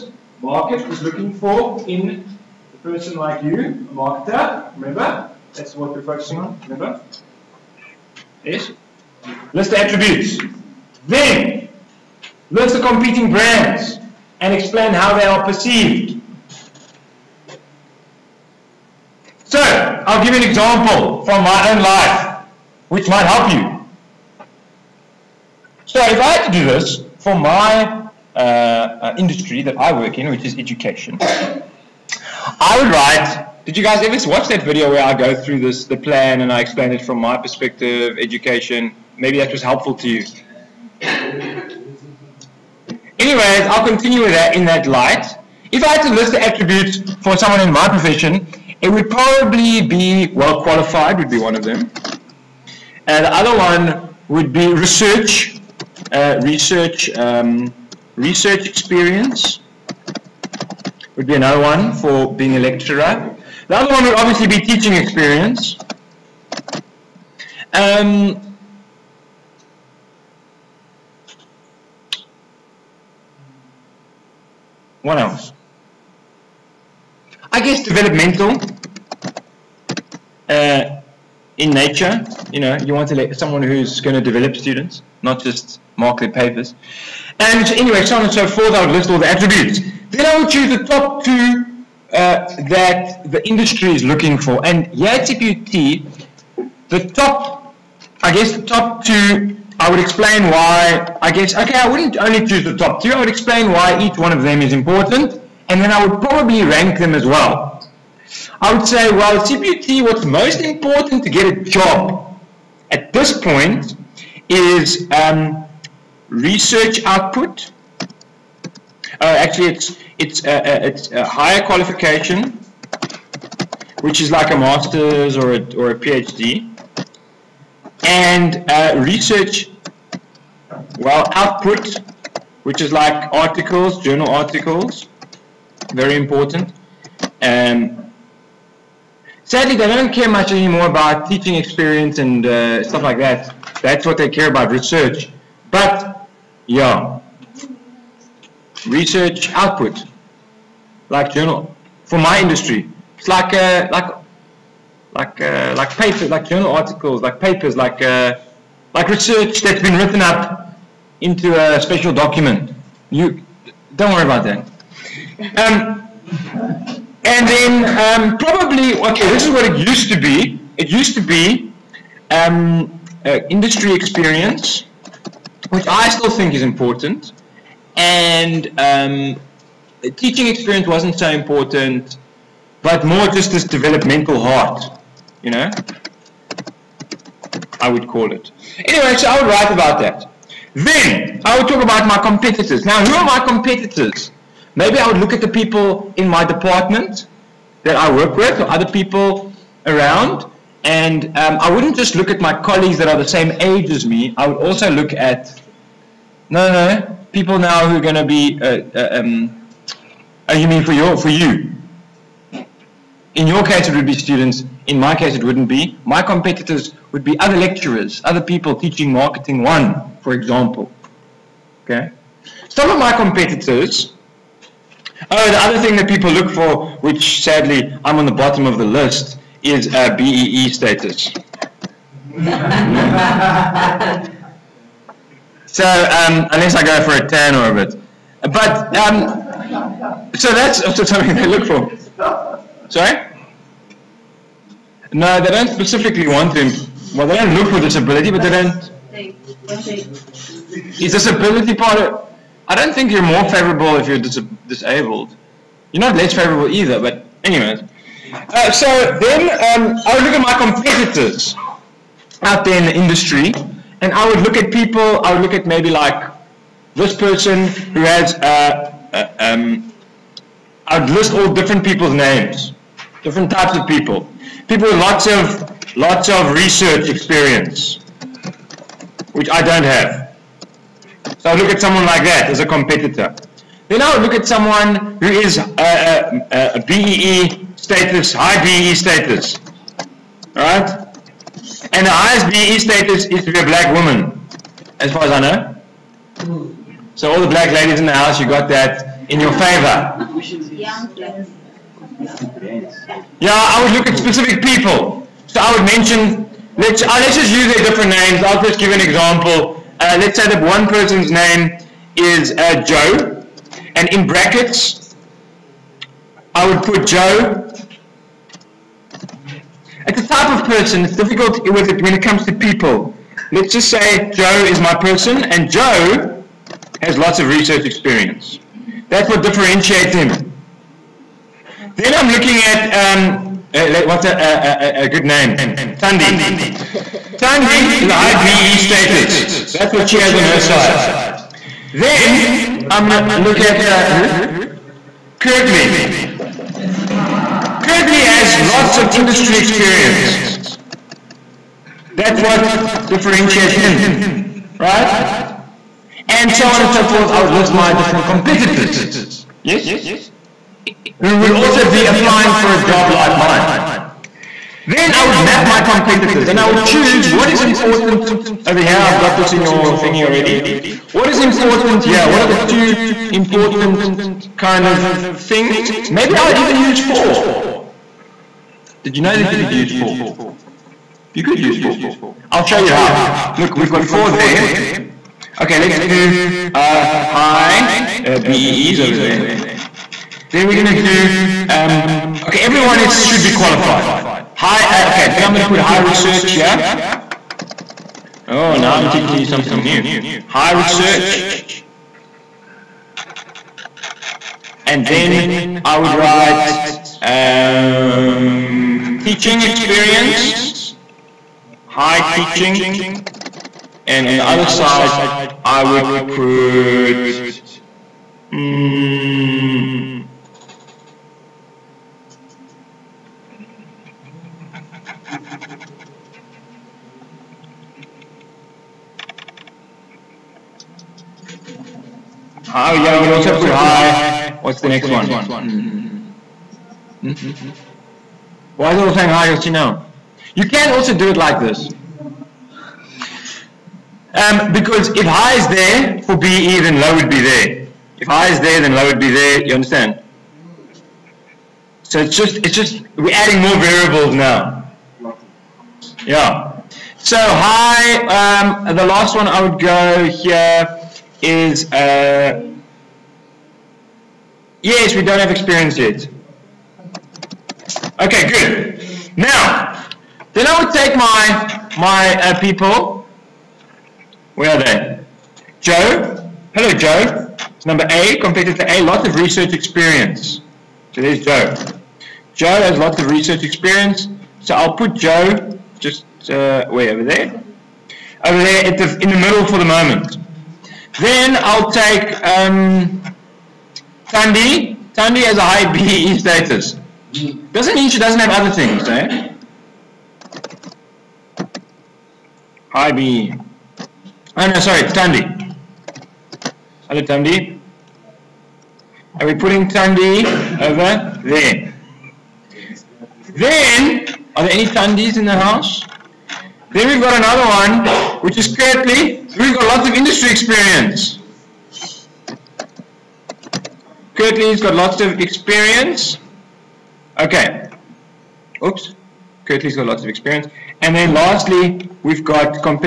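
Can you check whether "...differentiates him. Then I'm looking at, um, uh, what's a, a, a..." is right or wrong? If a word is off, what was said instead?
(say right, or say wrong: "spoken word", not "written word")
right.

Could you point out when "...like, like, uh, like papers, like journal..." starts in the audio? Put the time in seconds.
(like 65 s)
153 s.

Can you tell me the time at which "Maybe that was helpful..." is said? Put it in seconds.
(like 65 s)
39 s.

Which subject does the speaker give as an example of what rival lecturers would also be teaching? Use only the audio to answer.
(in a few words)
Marketing 1.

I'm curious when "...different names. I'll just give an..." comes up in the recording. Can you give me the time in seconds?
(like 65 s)
307 s.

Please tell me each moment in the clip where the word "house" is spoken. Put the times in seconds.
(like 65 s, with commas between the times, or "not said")
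298 s, 515 s.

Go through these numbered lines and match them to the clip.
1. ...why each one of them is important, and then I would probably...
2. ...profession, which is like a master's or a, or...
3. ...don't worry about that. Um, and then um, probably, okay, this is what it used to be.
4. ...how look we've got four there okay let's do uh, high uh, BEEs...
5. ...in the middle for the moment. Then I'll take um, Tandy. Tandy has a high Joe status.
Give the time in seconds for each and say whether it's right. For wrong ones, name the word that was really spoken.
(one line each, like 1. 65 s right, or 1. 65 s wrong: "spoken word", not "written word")
1. 103 s right
2. 121 s wrong: "qualification", not "profession"
3. 163 s right
4. 382 s right
5. 489 s wrong: "BEE", not "Joe".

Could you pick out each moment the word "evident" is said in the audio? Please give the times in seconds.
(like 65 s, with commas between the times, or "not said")
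not said.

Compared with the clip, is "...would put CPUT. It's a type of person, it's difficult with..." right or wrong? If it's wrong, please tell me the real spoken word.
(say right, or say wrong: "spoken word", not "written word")
wrong: "Joe", not "CPUT".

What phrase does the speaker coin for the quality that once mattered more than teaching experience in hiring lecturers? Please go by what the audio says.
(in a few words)
developmental heart.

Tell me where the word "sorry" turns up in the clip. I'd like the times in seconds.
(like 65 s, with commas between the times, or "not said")
242 s, 504 s.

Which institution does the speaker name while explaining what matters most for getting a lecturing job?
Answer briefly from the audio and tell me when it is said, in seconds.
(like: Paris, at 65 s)
CPUT, at 95 s.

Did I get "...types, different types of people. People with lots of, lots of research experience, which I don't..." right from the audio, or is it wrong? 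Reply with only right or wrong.
wrong.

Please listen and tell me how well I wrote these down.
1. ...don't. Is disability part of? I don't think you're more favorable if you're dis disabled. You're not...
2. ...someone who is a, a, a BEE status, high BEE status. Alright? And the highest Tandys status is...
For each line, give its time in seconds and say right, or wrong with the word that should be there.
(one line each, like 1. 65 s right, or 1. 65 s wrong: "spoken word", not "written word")
1. 248 s right
2. 284 s wrong: "BEE", not "Tandys".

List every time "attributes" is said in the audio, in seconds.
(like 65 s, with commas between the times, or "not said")
9 s, 46 s, 89 s.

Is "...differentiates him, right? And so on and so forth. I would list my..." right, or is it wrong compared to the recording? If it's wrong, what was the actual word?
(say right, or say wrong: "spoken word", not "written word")
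right.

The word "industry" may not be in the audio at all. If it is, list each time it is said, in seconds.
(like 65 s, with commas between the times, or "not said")
29 s, 93 s, 152 s, 173 s, 262 s, 349 s, 520 s.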